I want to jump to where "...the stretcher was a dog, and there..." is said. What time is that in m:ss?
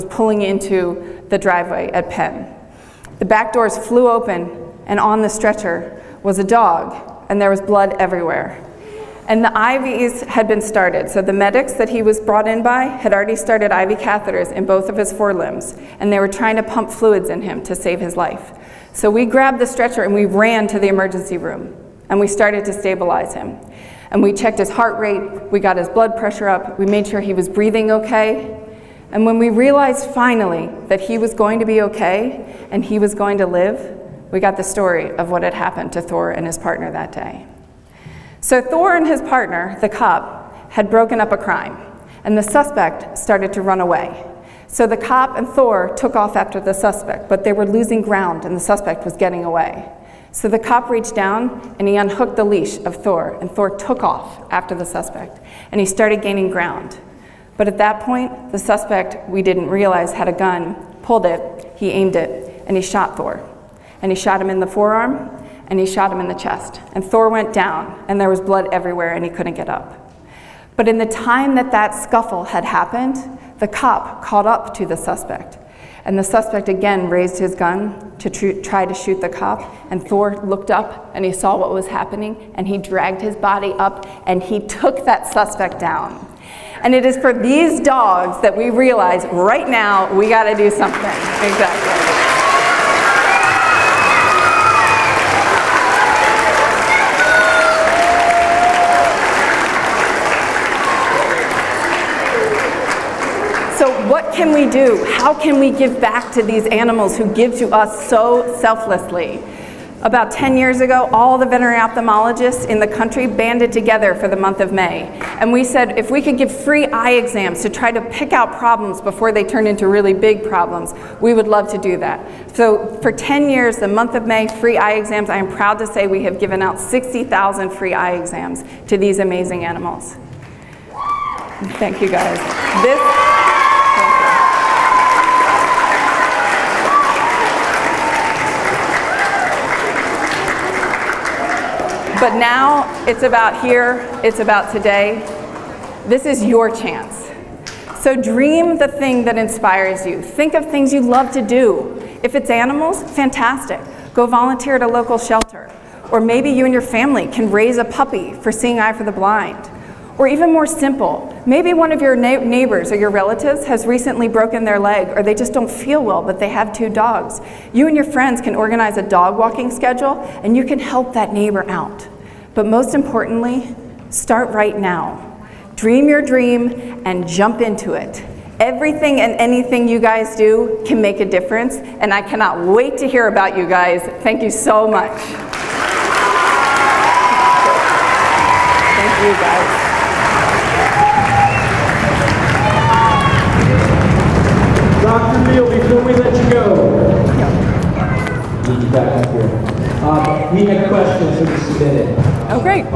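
0:05.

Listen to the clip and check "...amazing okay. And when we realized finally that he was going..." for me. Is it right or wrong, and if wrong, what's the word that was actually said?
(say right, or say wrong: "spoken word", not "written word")
wrong: "breathing", not "amazing".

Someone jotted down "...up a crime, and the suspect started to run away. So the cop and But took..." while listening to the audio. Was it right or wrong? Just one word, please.
wrong.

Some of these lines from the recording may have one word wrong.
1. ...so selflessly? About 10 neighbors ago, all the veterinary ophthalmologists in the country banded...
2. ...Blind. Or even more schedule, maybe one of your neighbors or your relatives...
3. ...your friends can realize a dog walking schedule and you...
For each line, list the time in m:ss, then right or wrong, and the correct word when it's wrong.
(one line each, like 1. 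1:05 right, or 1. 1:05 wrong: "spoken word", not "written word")
1. 1:48 wrong: "years", not "neighbors"
2. 2:39 wrong: "simple", not "schedule"
3. 2:47 wrong: "organize", not "realize".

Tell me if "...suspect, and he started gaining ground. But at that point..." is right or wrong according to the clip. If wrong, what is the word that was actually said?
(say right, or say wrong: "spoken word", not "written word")
right.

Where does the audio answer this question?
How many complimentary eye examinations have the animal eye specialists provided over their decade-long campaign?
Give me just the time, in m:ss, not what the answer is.
2:06.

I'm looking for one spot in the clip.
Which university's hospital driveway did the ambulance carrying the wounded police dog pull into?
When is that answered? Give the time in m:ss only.
0:02.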